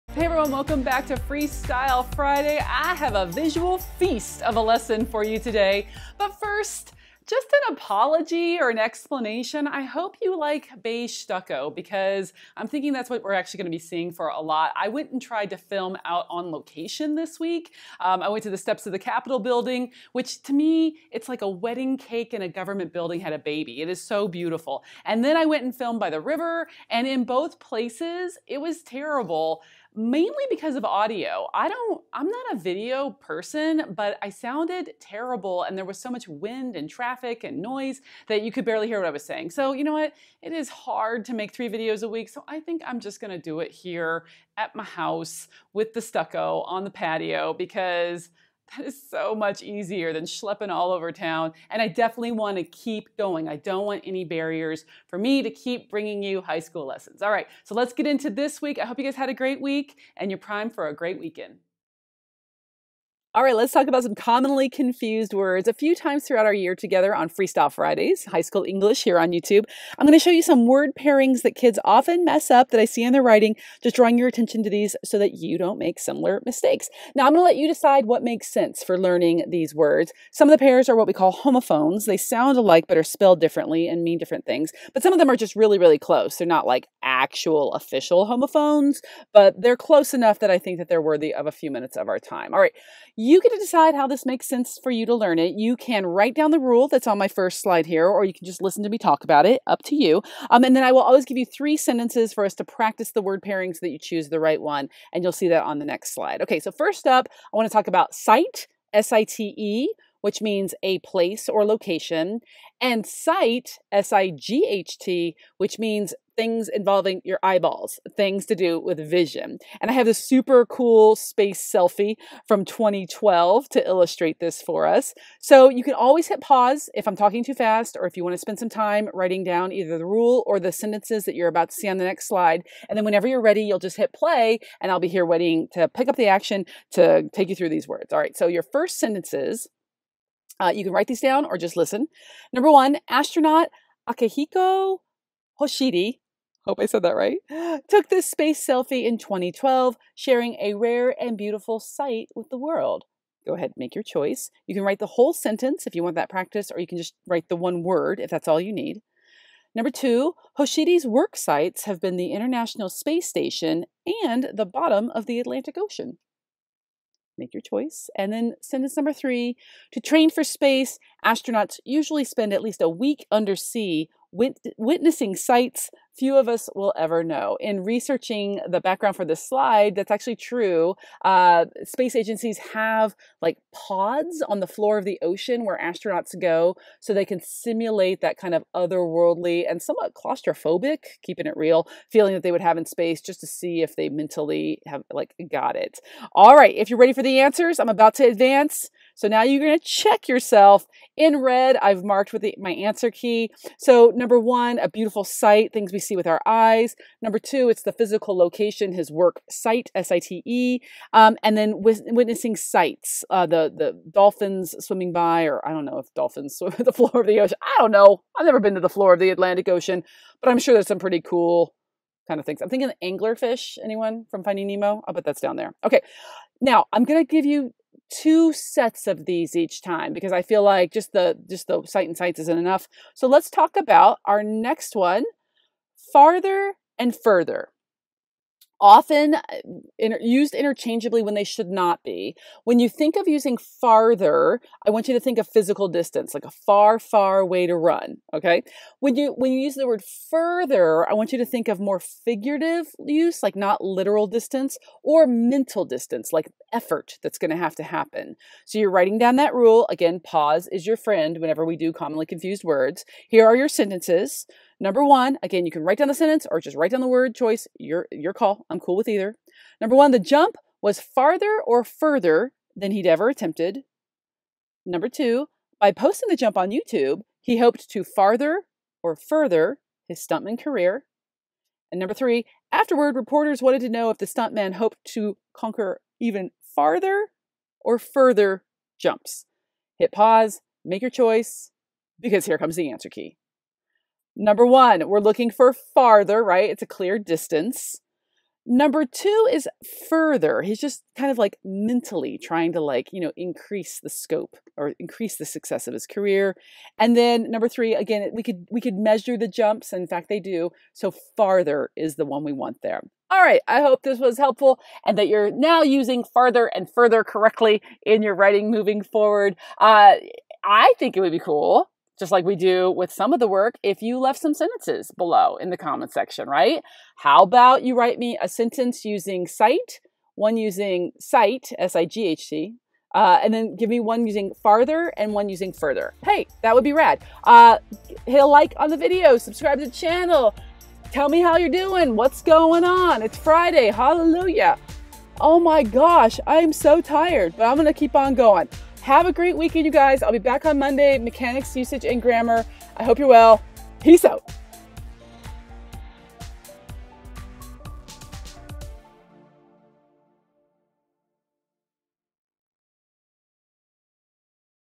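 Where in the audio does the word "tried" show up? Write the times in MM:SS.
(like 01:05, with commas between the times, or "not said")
00:15.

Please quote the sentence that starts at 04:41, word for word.
And number three, afterward, reporters wanted to know if the stuntman hoped to conquer even farther or further jumps.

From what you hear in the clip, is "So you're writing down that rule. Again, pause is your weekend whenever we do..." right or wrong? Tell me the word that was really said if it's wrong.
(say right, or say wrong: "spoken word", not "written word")
wrong: "friend", not "weekend".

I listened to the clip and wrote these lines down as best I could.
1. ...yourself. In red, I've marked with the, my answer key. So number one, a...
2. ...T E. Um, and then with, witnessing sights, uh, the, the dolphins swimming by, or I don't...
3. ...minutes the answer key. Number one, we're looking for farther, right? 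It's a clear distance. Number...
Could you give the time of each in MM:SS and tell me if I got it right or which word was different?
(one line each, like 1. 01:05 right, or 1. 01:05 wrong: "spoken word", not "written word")
1. 03:20 right
2. 03:30 right
3. 04:52 wrong: "comes", not "minutes".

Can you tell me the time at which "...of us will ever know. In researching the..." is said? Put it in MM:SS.
02:56.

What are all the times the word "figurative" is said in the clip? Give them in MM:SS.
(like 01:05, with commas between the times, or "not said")
04:11.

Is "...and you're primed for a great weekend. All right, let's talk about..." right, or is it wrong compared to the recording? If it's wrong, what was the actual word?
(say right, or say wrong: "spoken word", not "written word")
right.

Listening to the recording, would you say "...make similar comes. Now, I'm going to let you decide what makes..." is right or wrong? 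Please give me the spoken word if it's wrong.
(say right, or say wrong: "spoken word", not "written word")
wrong: "mistakes", not "comes".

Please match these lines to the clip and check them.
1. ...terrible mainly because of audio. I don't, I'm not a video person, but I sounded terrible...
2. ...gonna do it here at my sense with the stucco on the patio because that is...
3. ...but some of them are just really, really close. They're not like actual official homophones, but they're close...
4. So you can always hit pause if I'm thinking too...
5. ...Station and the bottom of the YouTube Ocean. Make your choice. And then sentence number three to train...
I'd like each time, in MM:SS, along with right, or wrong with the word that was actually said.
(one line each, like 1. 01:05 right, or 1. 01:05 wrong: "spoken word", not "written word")
1. 00:28 right
2. 00:43 wrong: "house", not "sense"
3. 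01:24 right
4. 02:05 wrong: "talking", not "thinking"
5. 02:43 wrong: "Atlantic", not "YouTube".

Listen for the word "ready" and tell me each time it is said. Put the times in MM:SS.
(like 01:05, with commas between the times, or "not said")
02:13, 03:16.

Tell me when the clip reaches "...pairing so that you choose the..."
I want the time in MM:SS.
01:43.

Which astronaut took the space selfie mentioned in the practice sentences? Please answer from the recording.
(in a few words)
Akihiko Hoshide.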